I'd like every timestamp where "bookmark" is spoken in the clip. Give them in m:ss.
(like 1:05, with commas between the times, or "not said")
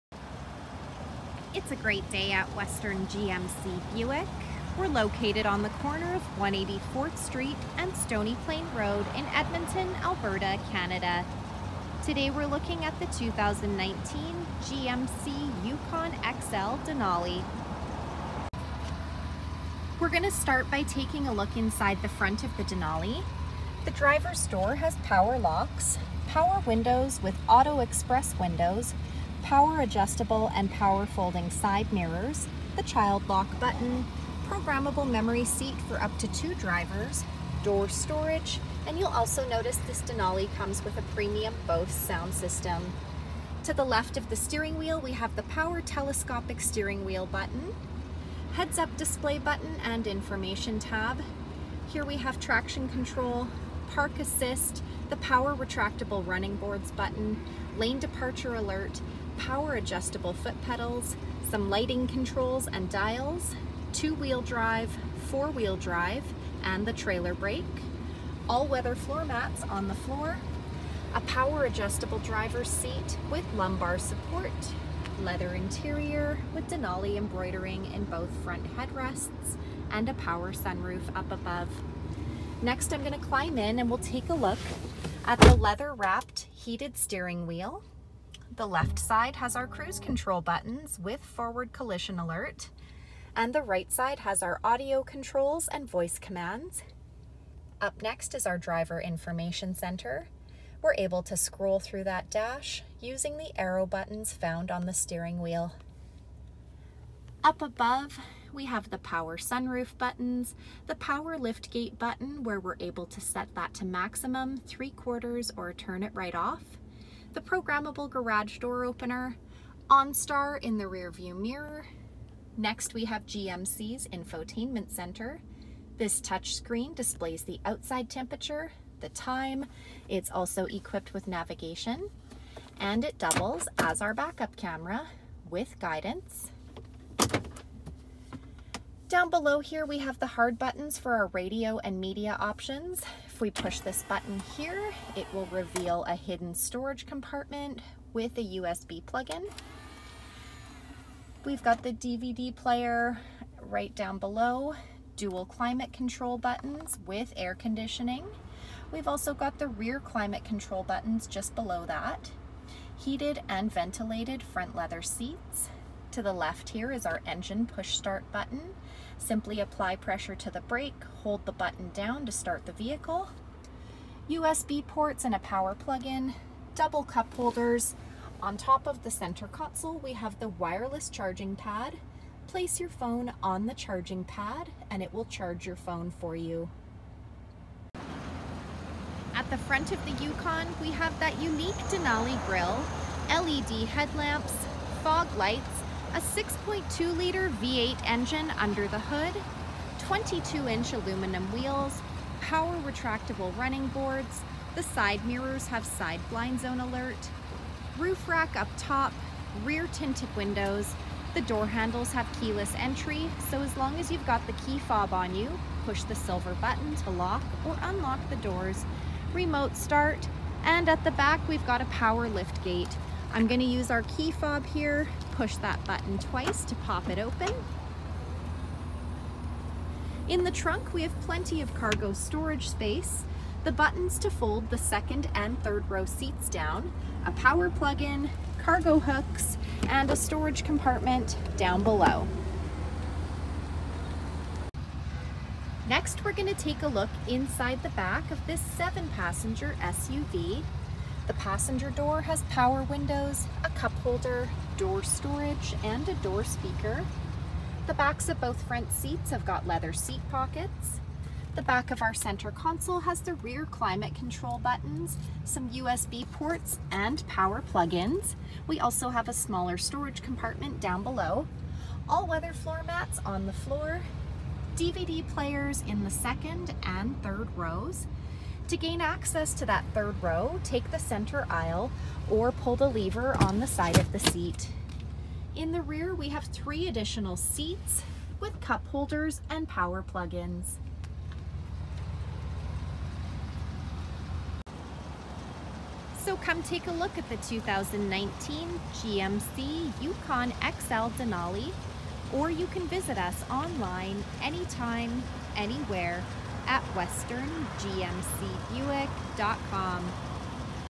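not said.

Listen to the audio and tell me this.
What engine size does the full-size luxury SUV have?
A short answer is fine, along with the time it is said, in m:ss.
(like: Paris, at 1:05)
6.2 liter V8, at 3:16.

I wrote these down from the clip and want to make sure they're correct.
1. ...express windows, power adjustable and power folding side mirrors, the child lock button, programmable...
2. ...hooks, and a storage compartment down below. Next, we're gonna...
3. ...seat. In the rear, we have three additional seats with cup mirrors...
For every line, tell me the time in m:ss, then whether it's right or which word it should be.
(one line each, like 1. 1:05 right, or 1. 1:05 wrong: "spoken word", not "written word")
1. 0:27 right
2. 3:58 right
3. 4:44 wrong: "holders", not "mirrors".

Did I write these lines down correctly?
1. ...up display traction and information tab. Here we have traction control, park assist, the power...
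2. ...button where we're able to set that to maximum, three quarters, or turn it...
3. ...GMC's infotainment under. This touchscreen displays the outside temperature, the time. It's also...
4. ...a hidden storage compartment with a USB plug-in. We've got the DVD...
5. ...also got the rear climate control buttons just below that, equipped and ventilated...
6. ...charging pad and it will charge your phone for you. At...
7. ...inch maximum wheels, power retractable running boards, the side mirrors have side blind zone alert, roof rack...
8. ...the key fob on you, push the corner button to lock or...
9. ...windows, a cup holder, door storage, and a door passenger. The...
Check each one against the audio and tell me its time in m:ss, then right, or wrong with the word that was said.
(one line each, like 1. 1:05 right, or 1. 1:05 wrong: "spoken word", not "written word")
1. 0:48 wrong: "button", not "traction"
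2. 1:51 right
3. 2:03 wrong: "center", not "under"
4. 2:26 right
5. 2:39 wrong: "heated", not "equipped"
6. 3:03 right
7. 3:20 wrong: "aluminum", not "maximum"
8. 3:34 wrong: "silver", not "corner"
9. 4:12 wrong: "speaker", not "passenger".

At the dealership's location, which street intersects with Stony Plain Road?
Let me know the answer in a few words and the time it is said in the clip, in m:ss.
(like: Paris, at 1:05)
184th Street, at 0:06.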